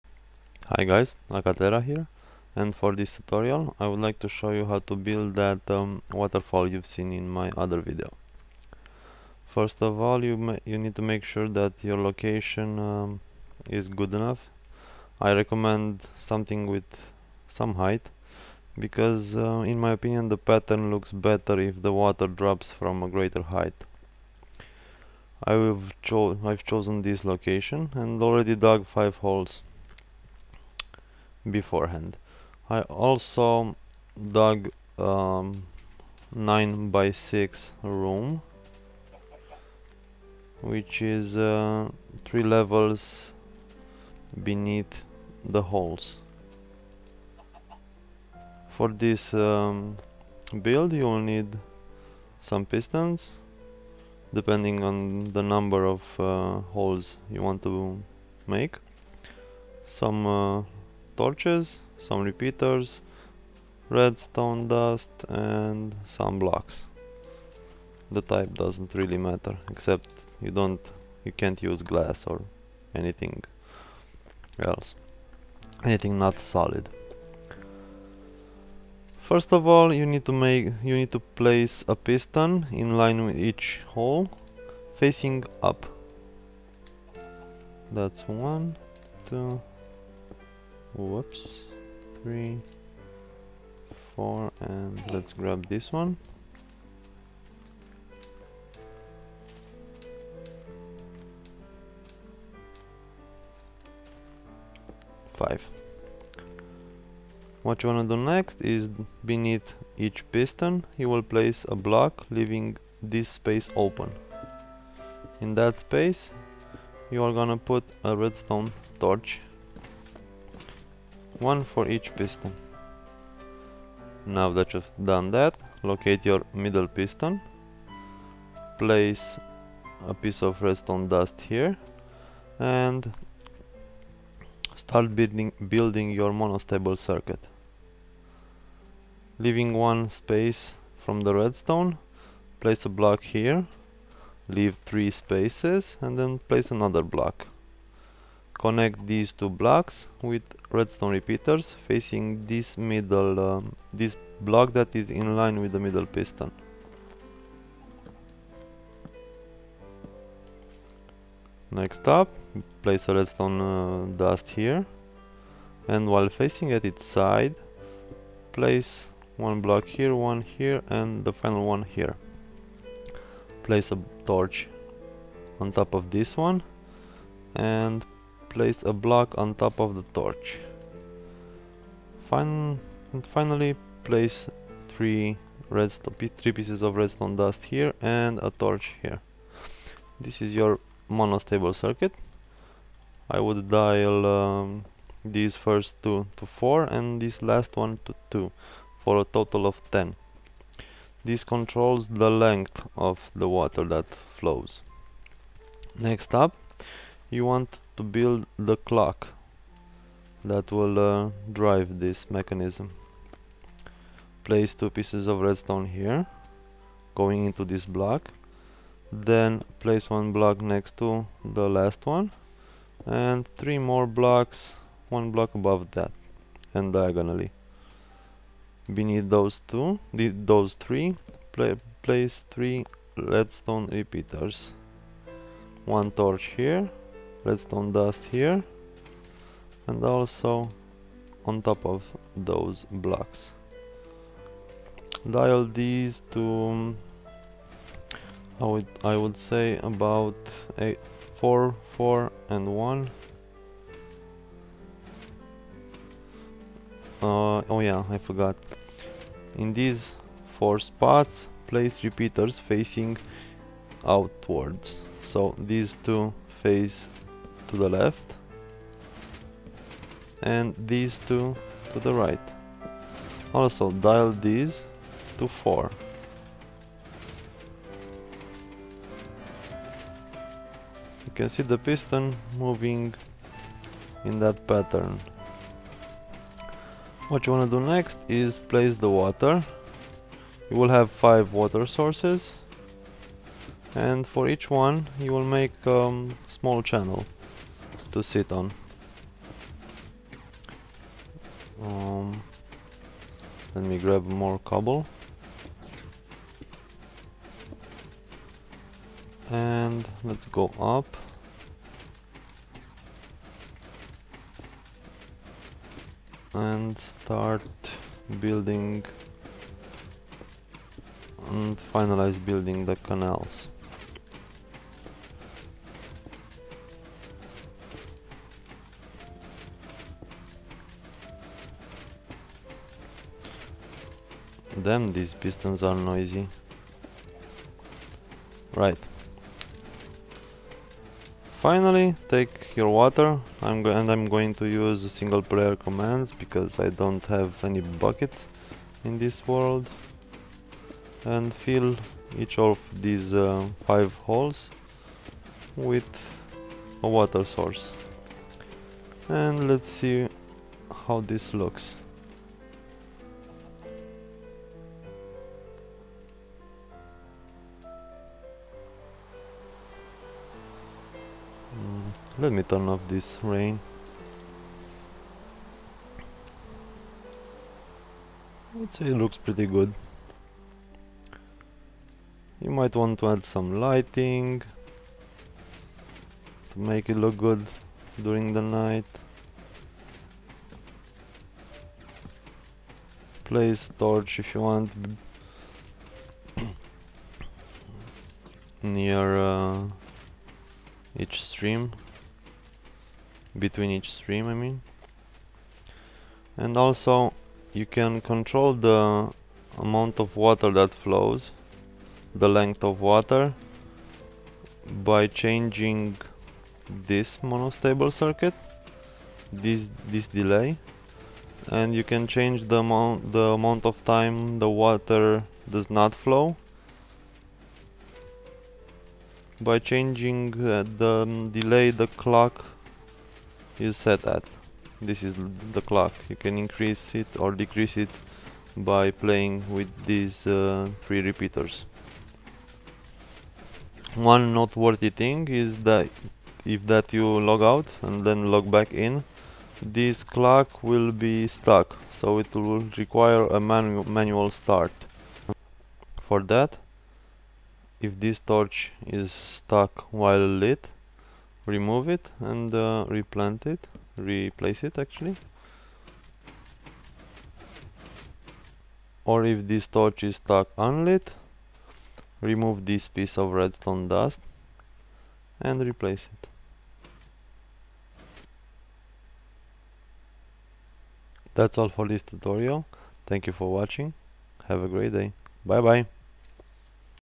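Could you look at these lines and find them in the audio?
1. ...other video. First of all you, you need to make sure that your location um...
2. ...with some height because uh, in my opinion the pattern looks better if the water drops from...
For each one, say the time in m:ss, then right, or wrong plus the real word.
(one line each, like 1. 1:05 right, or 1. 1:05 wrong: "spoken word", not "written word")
1. 0:07 right
2. 0:16 right.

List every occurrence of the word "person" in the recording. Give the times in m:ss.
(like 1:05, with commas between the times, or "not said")
not said.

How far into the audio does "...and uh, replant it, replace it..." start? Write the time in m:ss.
7:42.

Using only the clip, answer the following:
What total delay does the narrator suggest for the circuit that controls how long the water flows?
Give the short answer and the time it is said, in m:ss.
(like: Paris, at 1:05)
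10, at 3:19.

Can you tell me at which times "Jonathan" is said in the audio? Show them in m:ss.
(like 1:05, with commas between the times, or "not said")
not said.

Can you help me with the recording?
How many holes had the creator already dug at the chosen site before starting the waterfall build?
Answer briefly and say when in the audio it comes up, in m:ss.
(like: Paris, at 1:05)
5, at 0:28.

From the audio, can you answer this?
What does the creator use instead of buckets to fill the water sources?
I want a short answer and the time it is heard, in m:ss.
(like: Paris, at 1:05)
single player commands, at 5:45.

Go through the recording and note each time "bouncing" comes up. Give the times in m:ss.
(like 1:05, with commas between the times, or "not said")
not said.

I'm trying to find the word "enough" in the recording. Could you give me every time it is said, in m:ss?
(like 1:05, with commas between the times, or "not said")
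0:14.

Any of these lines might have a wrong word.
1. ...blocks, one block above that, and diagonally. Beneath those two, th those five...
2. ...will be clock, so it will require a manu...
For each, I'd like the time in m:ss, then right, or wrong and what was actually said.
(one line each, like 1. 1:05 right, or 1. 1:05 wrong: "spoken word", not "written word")
1. 3:44 wrong: "three", not "five"
2. 7:30 wrong: "stuck", not "clock".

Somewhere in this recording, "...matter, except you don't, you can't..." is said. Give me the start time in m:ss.
1:09.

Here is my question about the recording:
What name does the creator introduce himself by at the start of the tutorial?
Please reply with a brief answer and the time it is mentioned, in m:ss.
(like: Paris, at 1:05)
Akatera, at 0:01.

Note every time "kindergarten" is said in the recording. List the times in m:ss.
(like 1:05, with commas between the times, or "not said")
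not said.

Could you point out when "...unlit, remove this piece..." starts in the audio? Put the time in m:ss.
7:50.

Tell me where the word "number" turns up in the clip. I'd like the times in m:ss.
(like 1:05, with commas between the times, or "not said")
0:55.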